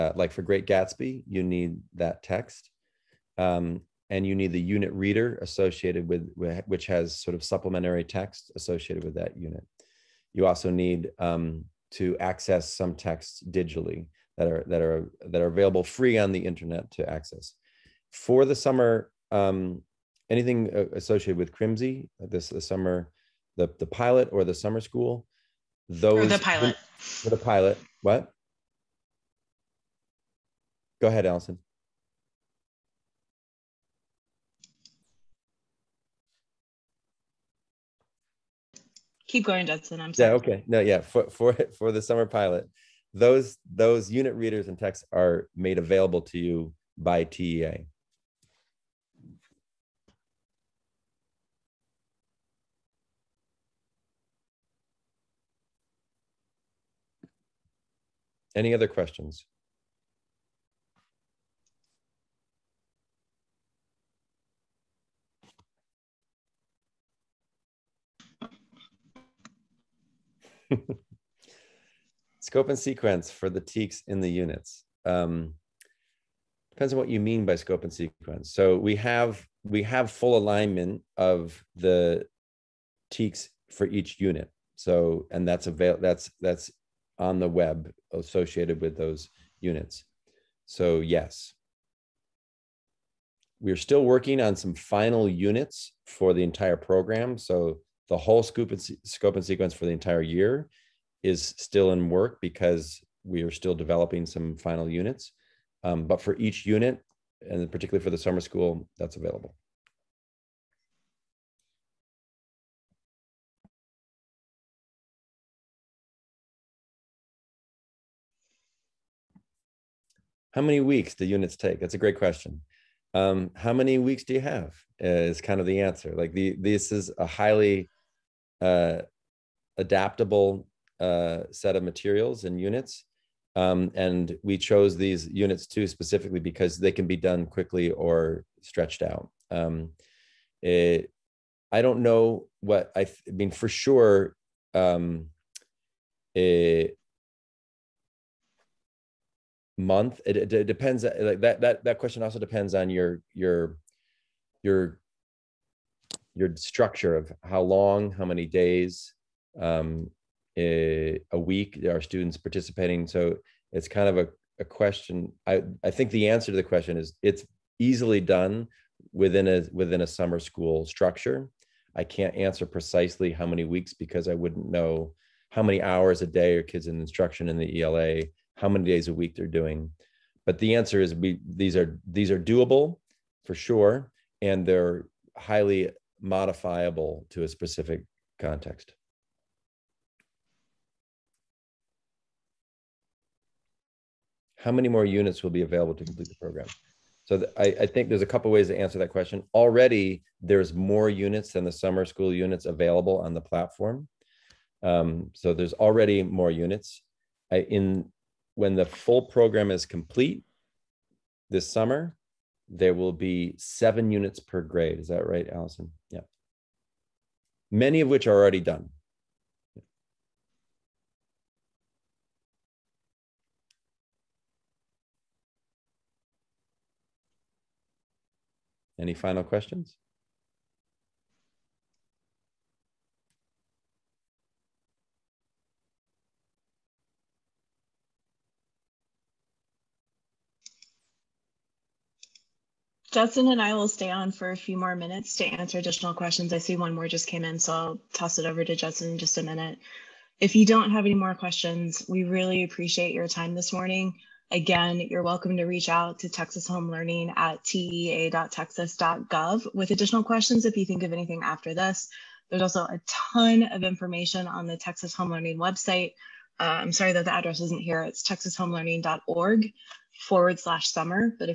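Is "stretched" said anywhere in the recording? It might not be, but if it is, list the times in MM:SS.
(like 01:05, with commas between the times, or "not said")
02:18.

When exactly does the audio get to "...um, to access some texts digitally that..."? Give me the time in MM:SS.
00:11.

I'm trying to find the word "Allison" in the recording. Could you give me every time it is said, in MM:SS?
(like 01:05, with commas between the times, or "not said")
00:31, 03:35.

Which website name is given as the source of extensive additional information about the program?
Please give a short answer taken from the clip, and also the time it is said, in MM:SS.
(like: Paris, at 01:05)
Texas Home Learning website, at 04:24.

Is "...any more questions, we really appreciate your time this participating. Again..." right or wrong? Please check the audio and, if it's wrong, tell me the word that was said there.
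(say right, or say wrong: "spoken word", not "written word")
wrong: "morning", not "participating".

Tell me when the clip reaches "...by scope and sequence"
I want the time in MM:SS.
01:17.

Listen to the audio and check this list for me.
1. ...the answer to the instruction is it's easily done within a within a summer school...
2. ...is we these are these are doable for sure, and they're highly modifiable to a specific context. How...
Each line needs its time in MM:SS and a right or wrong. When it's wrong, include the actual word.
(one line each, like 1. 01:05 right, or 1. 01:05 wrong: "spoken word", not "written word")
1. 02:46 wrong: "question", not "instruction"
2. 03:00 right.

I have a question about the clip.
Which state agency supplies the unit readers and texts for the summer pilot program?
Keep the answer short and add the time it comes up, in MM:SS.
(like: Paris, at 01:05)
TEA, at 00:47.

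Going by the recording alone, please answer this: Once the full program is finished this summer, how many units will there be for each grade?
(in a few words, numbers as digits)
7.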